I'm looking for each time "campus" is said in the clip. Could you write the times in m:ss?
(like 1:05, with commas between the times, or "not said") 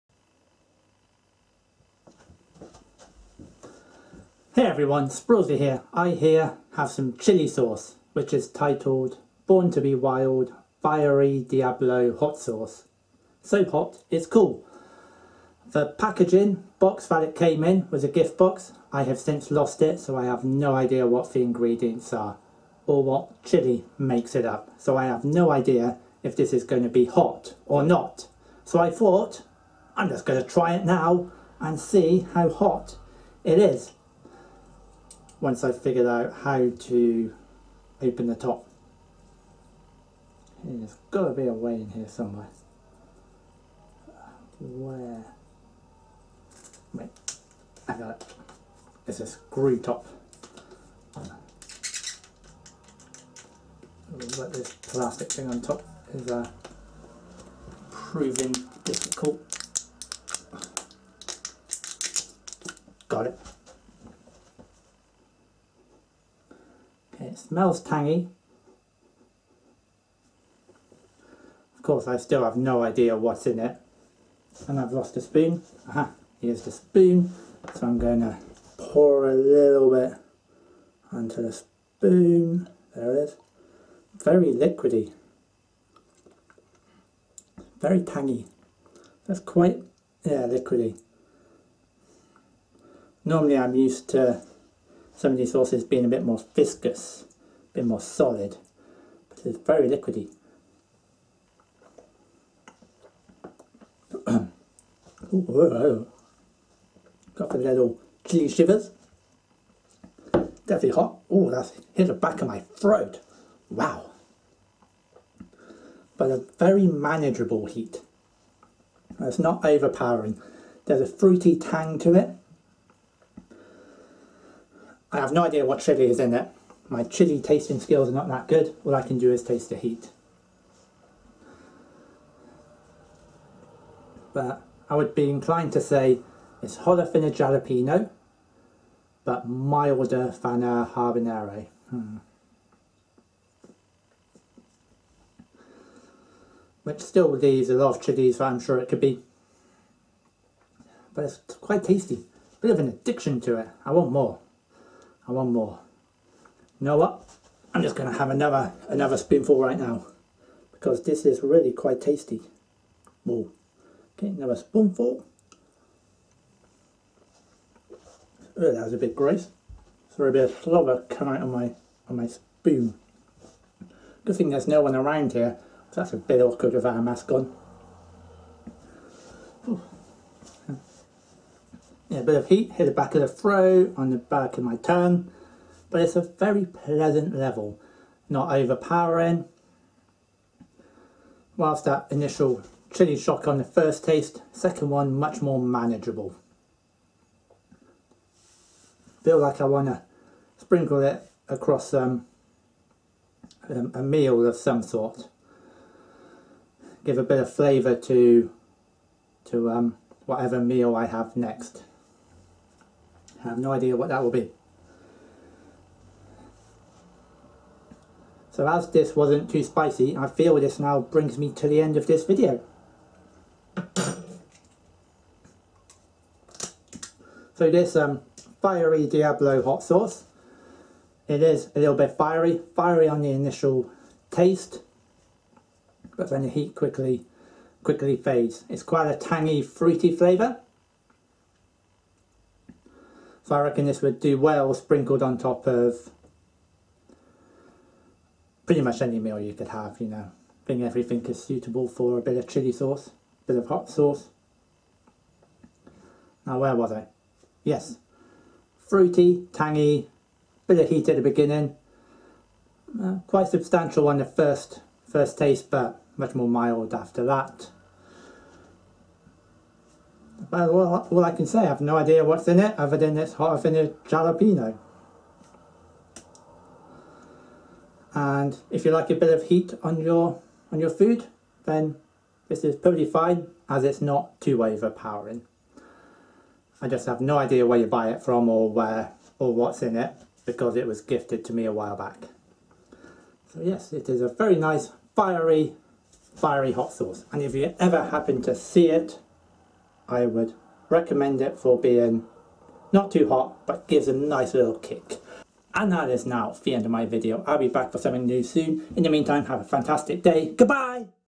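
not said.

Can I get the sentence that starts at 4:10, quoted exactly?
I think everything is suitable for a bit of chili sauce, bit of hot sauce.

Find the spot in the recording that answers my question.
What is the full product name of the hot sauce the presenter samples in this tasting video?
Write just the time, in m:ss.
0:09.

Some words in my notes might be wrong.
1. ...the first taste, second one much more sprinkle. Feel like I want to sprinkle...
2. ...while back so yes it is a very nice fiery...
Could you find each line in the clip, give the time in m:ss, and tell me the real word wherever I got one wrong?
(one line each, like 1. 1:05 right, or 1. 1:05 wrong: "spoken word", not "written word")
1. 3:13 wrong: "manageable", not "sprinkle"
2. 4:51 right.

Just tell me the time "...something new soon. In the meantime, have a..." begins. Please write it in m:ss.
5:07.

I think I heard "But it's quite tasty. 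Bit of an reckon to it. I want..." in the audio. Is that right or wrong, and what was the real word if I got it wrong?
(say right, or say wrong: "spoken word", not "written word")
wrong: "addiction", not "reckon".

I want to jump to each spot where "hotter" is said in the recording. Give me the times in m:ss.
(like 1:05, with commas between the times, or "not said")
2:16, 4:33.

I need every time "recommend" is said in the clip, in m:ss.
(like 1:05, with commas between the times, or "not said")
5:00.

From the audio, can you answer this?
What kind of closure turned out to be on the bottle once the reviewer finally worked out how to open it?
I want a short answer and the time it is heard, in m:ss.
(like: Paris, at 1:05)
Screw top, at 0:49.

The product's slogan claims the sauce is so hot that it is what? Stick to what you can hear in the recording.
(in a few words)
Cool.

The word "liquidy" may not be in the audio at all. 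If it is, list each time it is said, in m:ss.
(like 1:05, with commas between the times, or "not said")
1:24, 1:30, 1:39.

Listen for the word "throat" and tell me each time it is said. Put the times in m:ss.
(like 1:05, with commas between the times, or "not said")
1:52, 3:03.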